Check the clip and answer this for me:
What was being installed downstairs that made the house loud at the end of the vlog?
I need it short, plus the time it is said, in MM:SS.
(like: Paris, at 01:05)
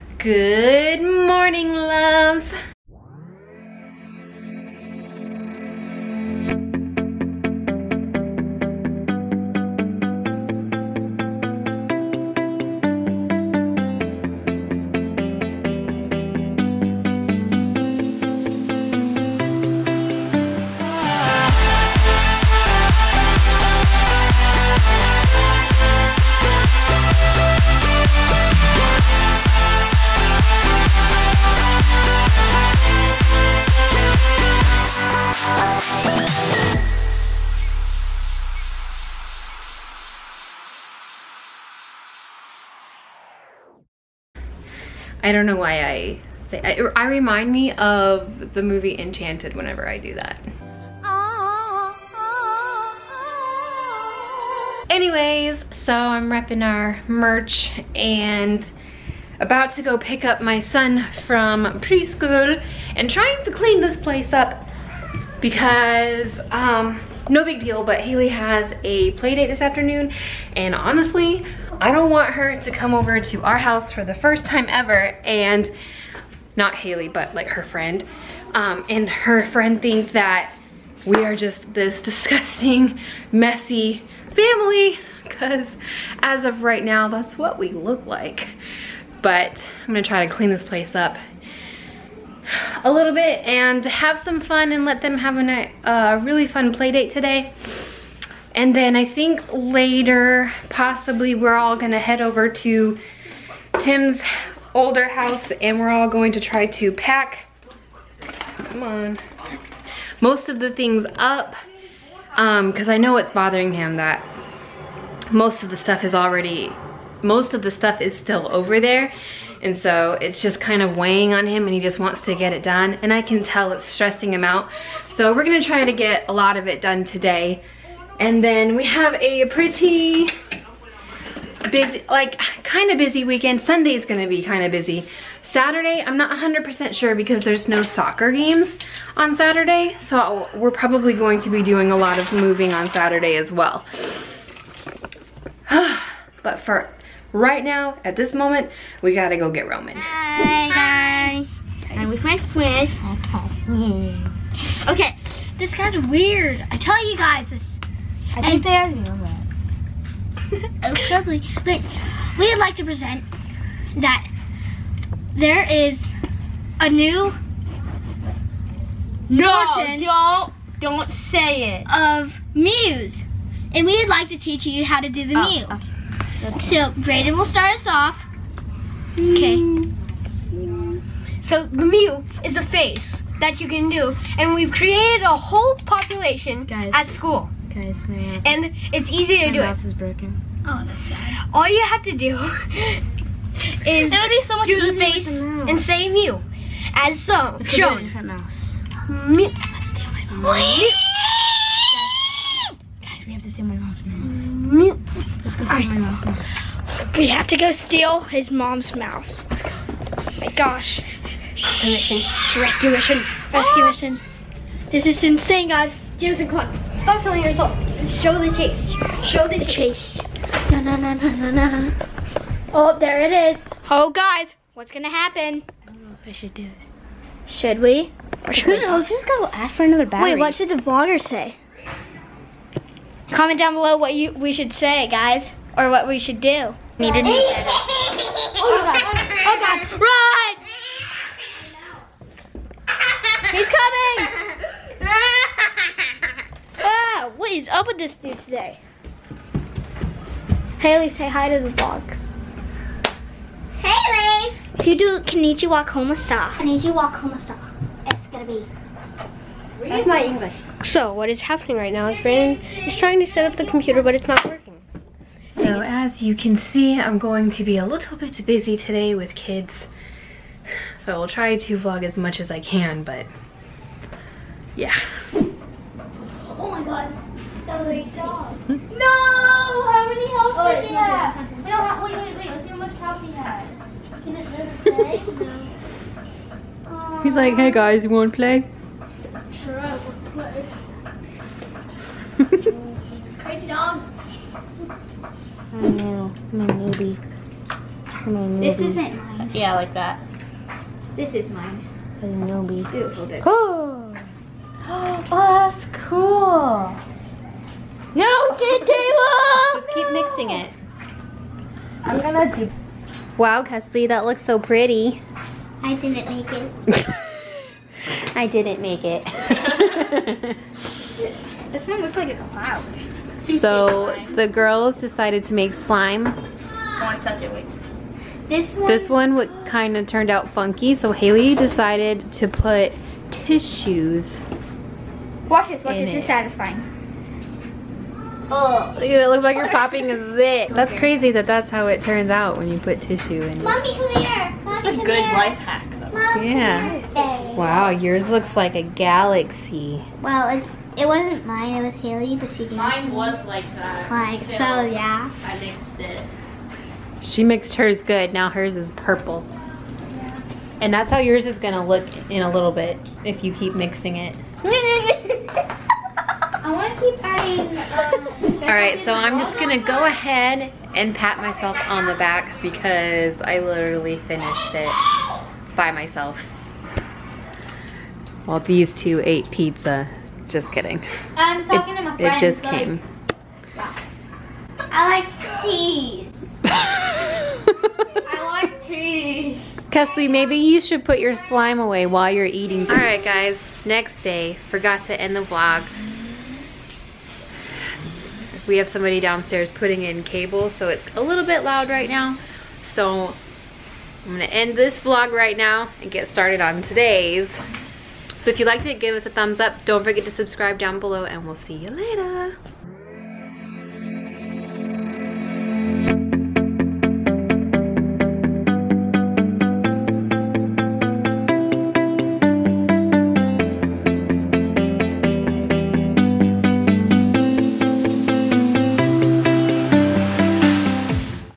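Cable, at 06:40.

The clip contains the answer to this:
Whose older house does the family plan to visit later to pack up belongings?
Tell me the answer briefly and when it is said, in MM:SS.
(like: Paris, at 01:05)
Tim's, at 01:43.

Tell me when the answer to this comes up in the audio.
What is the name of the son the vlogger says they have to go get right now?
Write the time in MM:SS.
02:29.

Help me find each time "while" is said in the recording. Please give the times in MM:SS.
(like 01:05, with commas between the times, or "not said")
06:18, 06:32.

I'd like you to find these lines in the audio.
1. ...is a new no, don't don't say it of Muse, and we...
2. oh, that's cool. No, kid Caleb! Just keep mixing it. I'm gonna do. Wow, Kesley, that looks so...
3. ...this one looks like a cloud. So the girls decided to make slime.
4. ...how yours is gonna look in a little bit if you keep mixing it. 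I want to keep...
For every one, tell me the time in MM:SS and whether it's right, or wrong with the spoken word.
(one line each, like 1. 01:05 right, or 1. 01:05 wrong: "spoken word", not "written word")
1. 02:45 right
2. 05:04 right
3. 05:21 right
4. 06:01 right.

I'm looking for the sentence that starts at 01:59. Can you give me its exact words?
And so it's just kind of weighing on him and he just wants to get it done.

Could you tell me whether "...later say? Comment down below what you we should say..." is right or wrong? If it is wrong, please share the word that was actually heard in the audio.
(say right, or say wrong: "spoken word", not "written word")
wrong: "vlogger", not "later".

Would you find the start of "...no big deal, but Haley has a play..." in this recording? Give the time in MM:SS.
01:07.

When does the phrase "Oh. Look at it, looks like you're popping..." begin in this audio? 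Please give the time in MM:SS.
05:38.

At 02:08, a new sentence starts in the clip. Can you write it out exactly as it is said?
And then we have a pretty busy, like kind of busy weekend.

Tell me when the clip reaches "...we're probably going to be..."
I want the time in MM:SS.
02:20.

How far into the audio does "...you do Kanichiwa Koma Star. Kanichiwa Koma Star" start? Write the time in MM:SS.
04:14.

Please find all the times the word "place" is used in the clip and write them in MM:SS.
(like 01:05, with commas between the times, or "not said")
01:03, 01:30.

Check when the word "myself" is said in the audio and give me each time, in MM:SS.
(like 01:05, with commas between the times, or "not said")
06:11, 06:15.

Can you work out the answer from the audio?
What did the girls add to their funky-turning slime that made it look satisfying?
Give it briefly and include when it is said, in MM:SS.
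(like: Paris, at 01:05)
Tissues, at 05:33.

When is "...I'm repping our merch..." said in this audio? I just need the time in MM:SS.
00:55.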